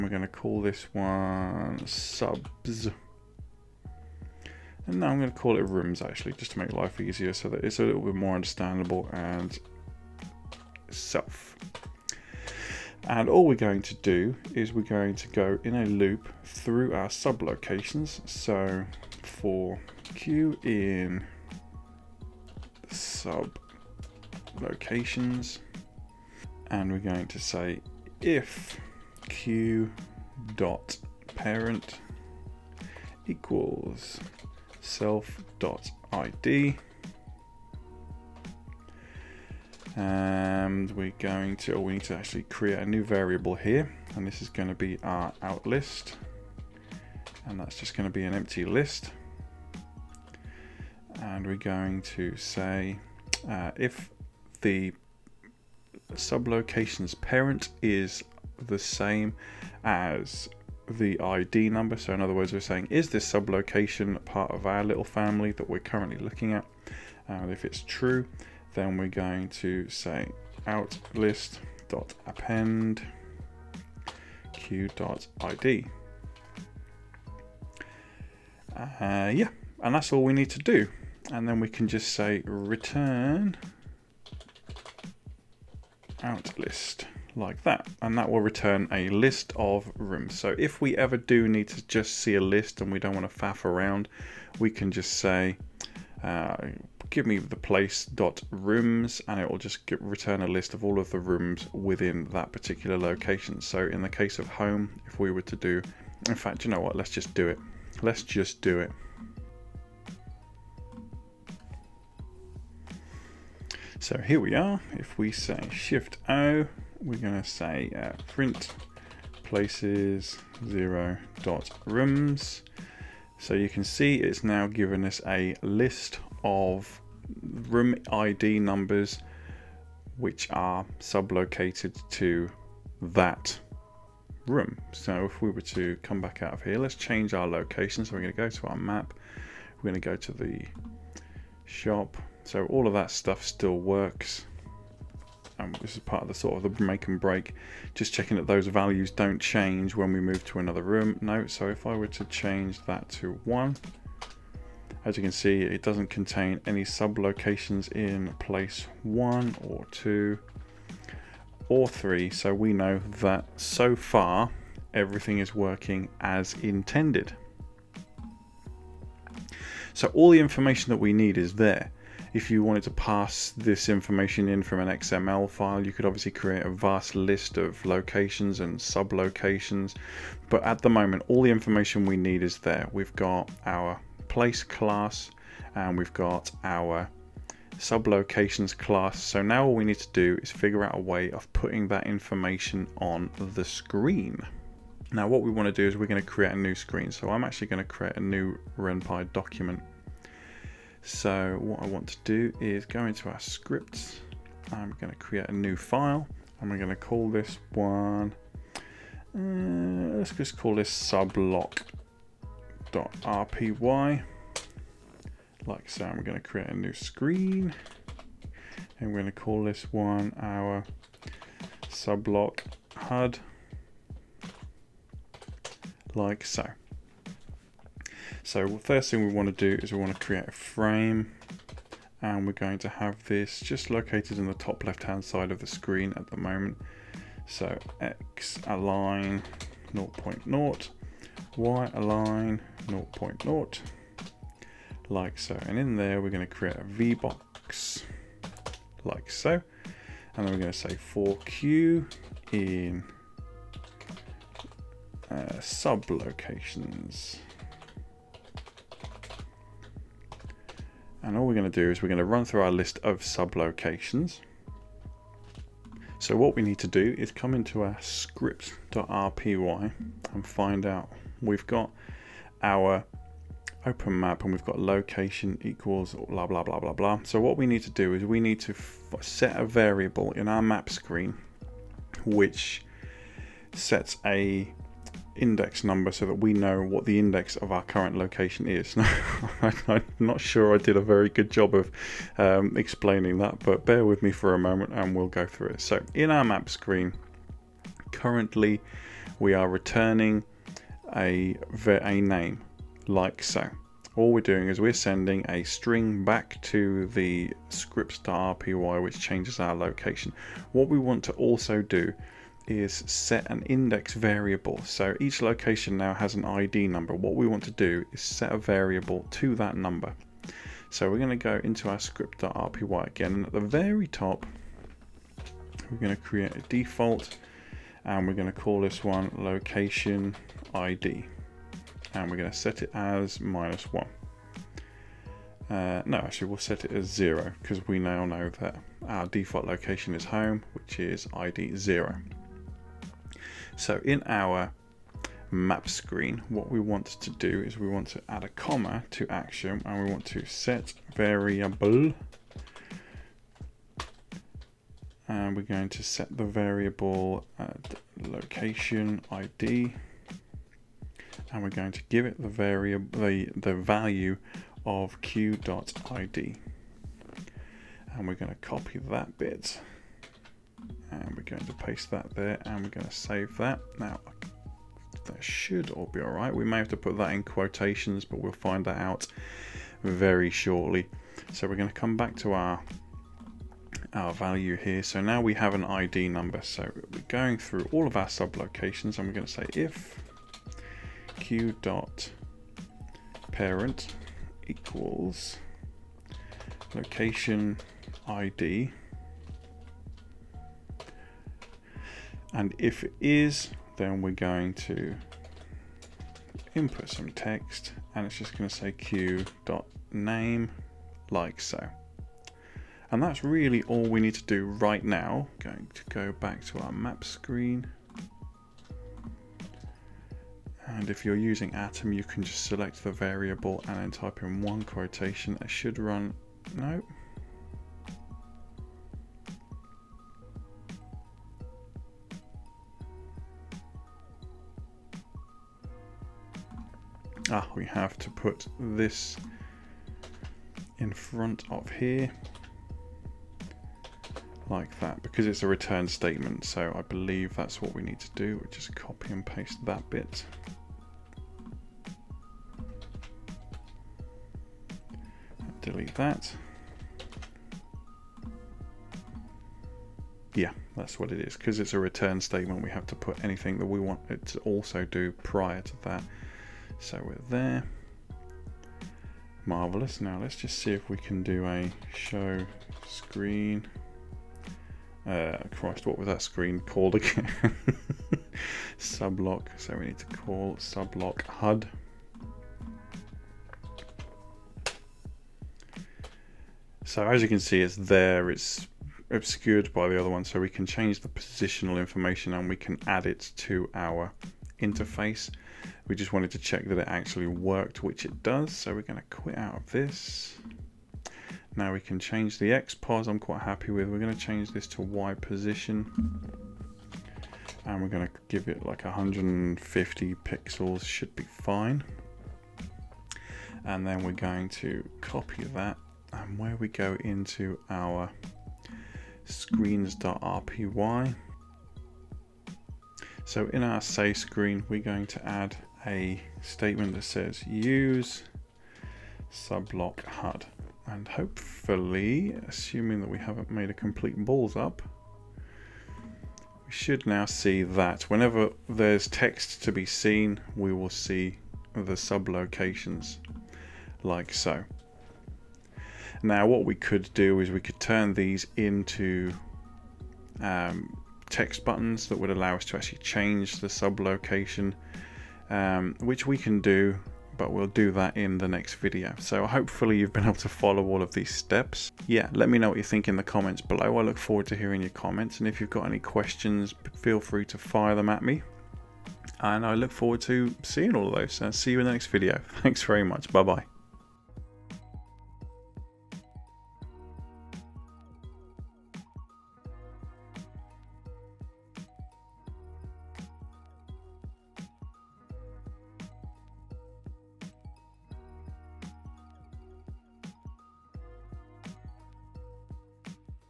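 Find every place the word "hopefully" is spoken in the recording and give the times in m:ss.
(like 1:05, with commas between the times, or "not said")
8:51, 9:19.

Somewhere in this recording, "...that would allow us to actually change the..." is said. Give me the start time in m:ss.
9:12.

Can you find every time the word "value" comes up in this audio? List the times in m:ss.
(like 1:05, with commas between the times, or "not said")
2:28, 6:03, 6:24.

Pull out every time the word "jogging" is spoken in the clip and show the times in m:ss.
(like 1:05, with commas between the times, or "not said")
not said.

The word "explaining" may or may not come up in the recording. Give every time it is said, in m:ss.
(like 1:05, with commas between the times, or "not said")
4:52.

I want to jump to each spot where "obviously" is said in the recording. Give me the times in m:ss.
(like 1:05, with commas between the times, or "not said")
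2:56.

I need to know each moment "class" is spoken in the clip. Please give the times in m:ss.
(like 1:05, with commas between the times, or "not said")
3:04, 3:08.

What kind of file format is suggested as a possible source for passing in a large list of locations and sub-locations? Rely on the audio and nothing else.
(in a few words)
XML.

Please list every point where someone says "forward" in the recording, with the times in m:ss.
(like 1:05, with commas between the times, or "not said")
9:24, 9:30.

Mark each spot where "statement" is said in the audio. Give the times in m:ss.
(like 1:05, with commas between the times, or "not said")
7:26, 7:42, 8:46.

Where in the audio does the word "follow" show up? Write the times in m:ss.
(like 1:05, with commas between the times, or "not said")
9:20.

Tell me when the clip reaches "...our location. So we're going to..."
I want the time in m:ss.
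2:17.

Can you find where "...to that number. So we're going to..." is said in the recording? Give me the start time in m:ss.
5:19.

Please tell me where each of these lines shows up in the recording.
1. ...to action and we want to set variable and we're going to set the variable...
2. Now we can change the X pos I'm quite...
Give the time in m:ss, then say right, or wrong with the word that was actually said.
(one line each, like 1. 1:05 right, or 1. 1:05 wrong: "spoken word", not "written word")
1. 5:49 right
2. 8:21 right.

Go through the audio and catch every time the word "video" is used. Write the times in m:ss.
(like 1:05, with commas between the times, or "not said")
9:18, 9:32.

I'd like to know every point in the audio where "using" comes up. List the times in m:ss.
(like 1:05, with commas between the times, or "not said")
7:01.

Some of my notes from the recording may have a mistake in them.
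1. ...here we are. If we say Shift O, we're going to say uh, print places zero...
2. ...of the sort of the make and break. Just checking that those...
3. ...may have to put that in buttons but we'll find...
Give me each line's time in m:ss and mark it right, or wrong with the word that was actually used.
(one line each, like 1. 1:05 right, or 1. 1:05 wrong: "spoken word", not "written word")
1. 1:54 right
2. 2:26 right
3. 6:16 wrong: "quotations", not "buttons".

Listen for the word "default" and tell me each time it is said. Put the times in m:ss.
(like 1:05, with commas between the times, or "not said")
5:26, 5:39.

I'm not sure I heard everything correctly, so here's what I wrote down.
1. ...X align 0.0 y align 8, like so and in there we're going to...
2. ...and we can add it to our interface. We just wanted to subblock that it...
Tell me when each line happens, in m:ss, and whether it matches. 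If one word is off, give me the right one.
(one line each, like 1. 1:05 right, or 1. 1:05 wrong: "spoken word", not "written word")
1. 3:58 wrong: "0", not "8"
2. 8:12 wrong: "check", not "subblock".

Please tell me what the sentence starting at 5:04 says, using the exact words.
All we're doing is we're sending a string back to the script.py which changes our location.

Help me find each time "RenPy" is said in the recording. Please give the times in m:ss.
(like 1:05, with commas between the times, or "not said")
3:18.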